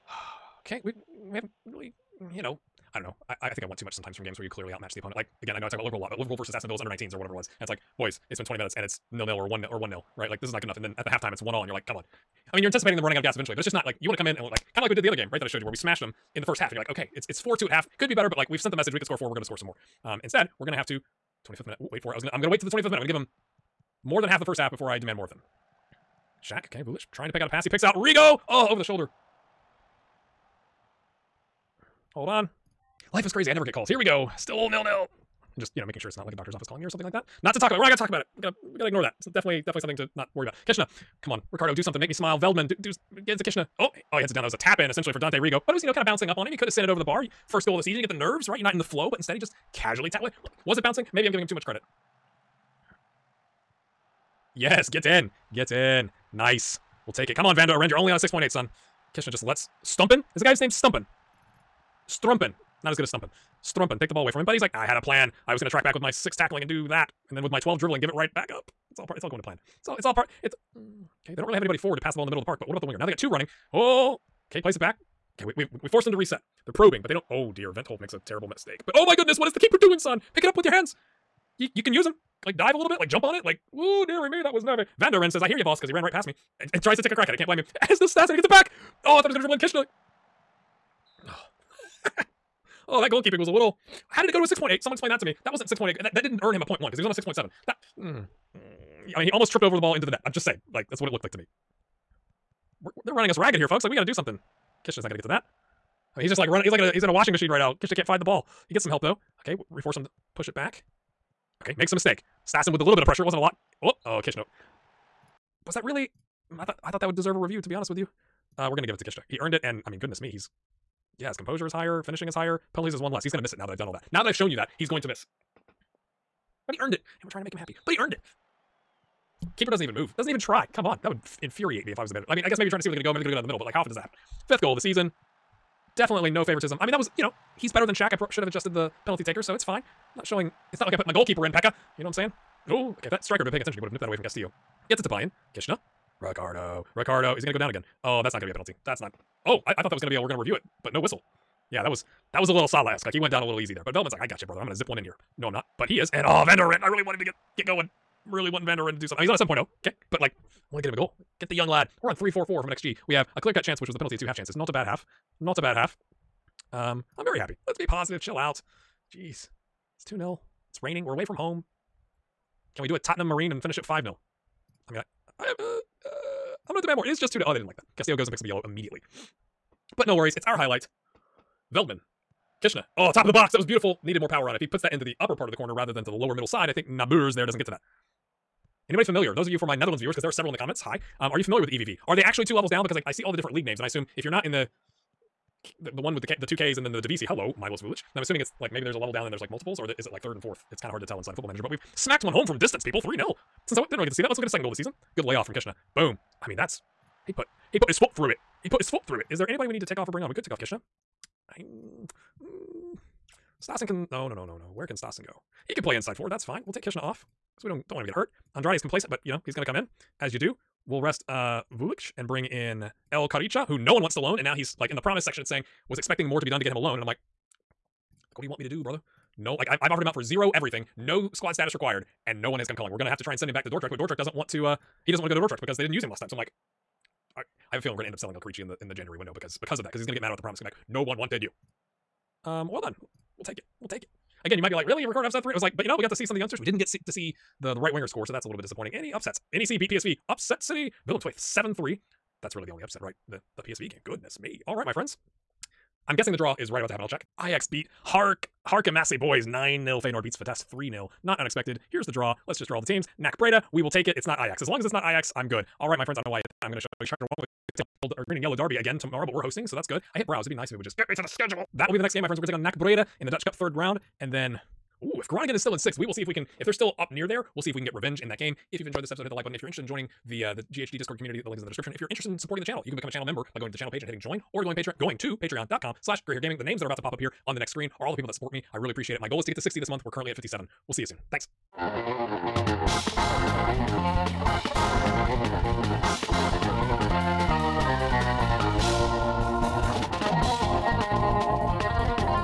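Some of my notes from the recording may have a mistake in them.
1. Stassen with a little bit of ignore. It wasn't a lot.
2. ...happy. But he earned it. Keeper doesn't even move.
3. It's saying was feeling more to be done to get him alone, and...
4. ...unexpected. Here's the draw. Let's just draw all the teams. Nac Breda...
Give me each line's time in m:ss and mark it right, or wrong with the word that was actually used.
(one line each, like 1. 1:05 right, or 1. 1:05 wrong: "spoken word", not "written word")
1. 1:52 wrong: "pressure", not "ignore"
2. 2:07 right
3. 3:45 wrong: "expecting", not "feeling"
4. 4:21 right.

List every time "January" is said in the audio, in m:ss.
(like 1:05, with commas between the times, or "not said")
3:58.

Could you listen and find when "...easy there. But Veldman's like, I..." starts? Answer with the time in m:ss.
2:33.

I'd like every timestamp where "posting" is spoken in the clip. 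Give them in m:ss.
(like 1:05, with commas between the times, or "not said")
not said.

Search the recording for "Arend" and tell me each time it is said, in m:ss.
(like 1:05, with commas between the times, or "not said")
0:57.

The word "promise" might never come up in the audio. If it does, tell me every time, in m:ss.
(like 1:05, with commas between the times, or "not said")
3:45, 4:00.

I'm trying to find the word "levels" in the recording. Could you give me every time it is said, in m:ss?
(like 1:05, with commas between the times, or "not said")
3:12, 3:18.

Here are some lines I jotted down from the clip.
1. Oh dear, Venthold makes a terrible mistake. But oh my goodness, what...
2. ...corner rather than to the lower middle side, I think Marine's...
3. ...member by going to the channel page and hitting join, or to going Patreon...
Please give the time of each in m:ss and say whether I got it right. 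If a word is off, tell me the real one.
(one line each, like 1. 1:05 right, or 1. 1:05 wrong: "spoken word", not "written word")
1. 1:17 right
2. 3:05 wrong: "Nabur", not "Marine"
3. 4:43 right.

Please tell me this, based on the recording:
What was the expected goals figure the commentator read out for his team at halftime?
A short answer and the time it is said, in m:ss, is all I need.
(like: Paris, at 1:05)
3.44, at 2:42.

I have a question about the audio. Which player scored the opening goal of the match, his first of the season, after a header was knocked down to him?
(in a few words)
Dante Rigo.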